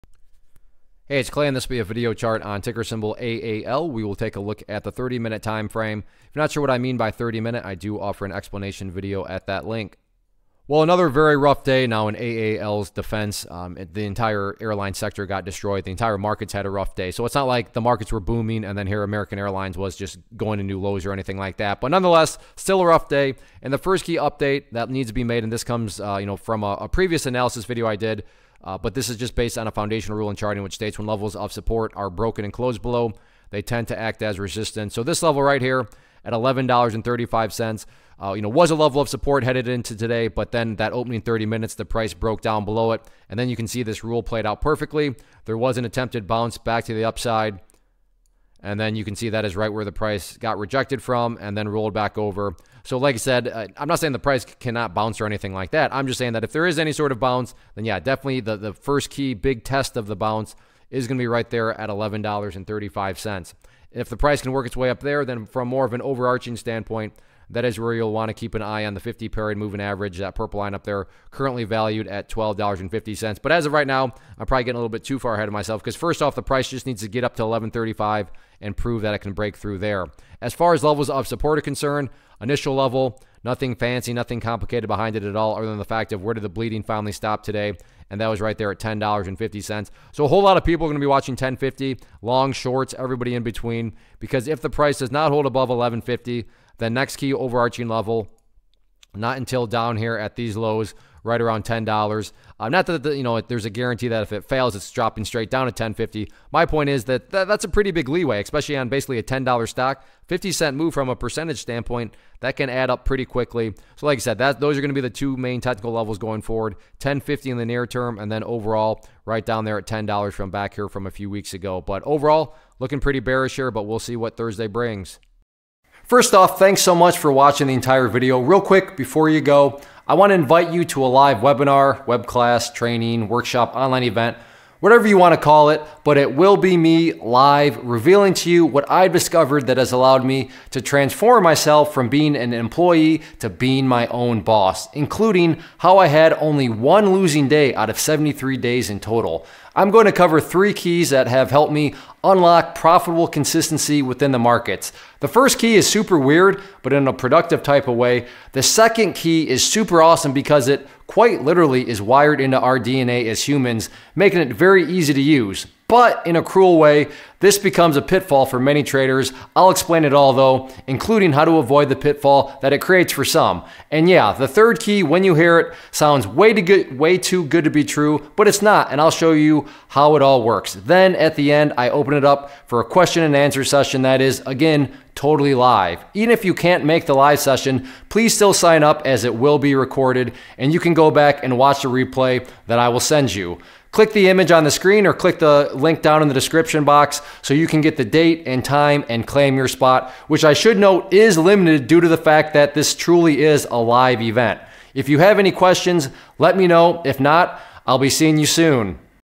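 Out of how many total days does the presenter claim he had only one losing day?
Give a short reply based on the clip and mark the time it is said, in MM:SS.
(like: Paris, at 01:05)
73, at 02:27.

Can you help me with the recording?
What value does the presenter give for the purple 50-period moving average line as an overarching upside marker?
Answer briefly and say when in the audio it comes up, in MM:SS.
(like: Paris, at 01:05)
$12.50, at 01:12.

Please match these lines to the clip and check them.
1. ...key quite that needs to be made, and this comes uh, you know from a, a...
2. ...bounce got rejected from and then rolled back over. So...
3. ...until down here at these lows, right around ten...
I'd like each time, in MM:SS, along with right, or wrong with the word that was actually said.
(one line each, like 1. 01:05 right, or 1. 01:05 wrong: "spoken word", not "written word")
1. 00:24 wrong: "update", not "quite"
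2. 00:49 wrong: "price", not "bounce"
3. 01:39 right.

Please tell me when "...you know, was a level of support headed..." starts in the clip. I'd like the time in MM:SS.
00:38.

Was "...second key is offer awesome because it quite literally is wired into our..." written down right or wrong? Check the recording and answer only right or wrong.
wrong.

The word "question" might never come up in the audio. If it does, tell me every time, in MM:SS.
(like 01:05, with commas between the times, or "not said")
03:02, 03:25.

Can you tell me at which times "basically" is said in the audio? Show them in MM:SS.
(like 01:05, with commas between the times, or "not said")
01:48.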